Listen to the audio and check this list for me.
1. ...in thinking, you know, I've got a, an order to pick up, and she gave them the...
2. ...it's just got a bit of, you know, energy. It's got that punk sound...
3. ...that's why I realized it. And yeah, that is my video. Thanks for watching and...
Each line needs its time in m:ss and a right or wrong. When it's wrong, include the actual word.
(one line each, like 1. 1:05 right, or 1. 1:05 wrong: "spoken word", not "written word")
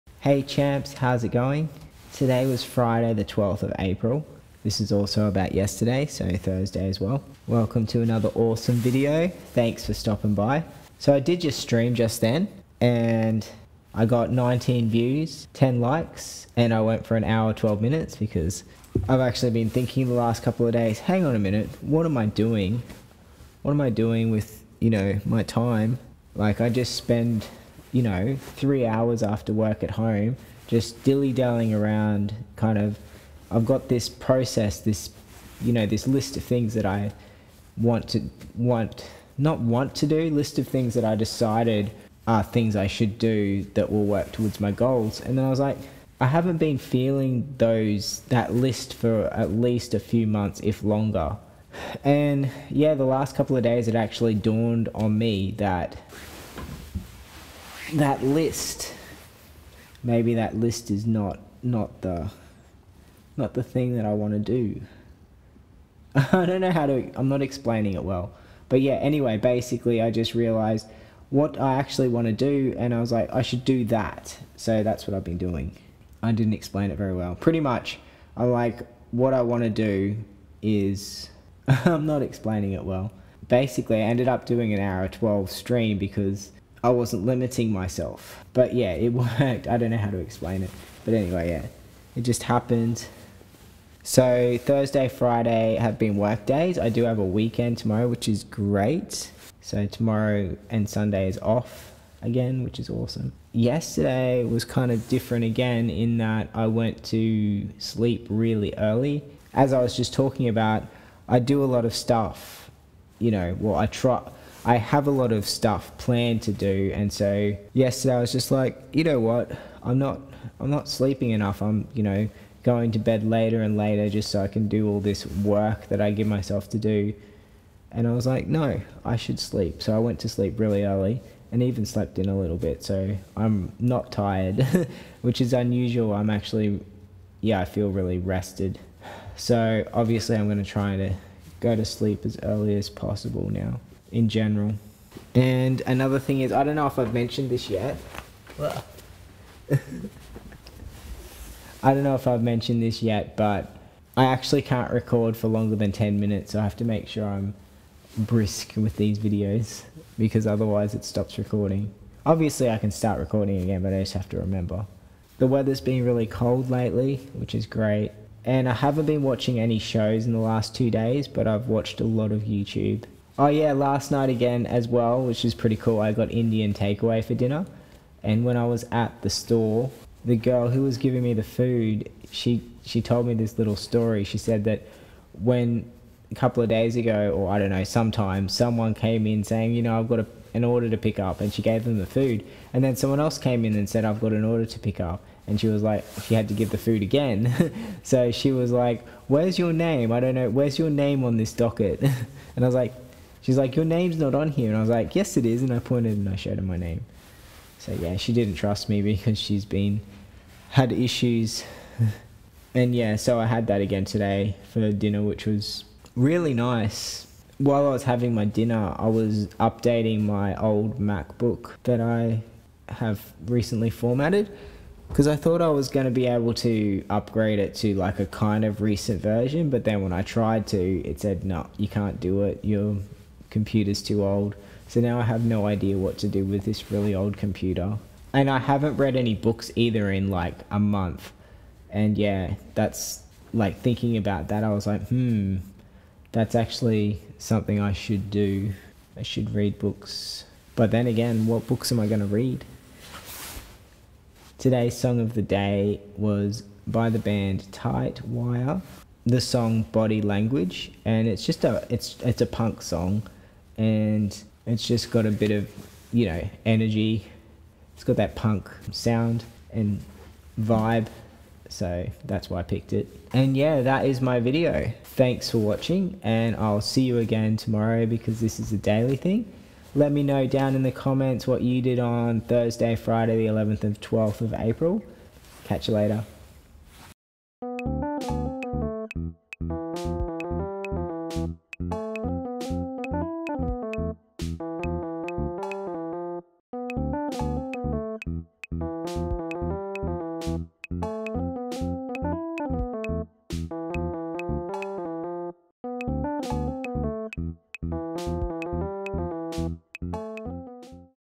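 1. 3:09 wrong: "saying", not "thinking"
2. 4:24 right
3. 4:32 wrong: "picked", not "realized".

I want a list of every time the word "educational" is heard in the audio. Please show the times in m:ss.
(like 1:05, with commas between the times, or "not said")
not said.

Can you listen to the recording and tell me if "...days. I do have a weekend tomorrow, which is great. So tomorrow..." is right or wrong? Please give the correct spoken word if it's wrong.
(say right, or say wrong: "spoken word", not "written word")
right.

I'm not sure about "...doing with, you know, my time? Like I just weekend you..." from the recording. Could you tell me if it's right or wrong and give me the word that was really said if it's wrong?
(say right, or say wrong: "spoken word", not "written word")
wrong: "spend", not "weekend".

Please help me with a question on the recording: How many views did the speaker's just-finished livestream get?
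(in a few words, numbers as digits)
19.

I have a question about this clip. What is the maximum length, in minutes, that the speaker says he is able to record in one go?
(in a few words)
10.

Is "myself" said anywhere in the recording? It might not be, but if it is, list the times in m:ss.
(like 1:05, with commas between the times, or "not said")
1:27, 2:06.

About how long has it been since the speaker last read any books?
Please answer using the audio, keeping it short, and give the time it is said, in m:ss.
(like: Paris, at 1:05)
a month, at 4:00.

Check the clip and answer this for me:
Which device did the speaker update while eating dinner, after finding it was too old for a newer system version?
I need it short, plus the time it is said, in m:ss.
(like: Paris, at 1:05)
MacBook, at 3:40.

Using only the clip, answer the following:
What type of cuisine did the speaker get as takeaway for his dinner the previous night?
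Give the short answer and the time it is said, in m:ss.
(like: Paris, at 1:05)
Indian, at 2:56.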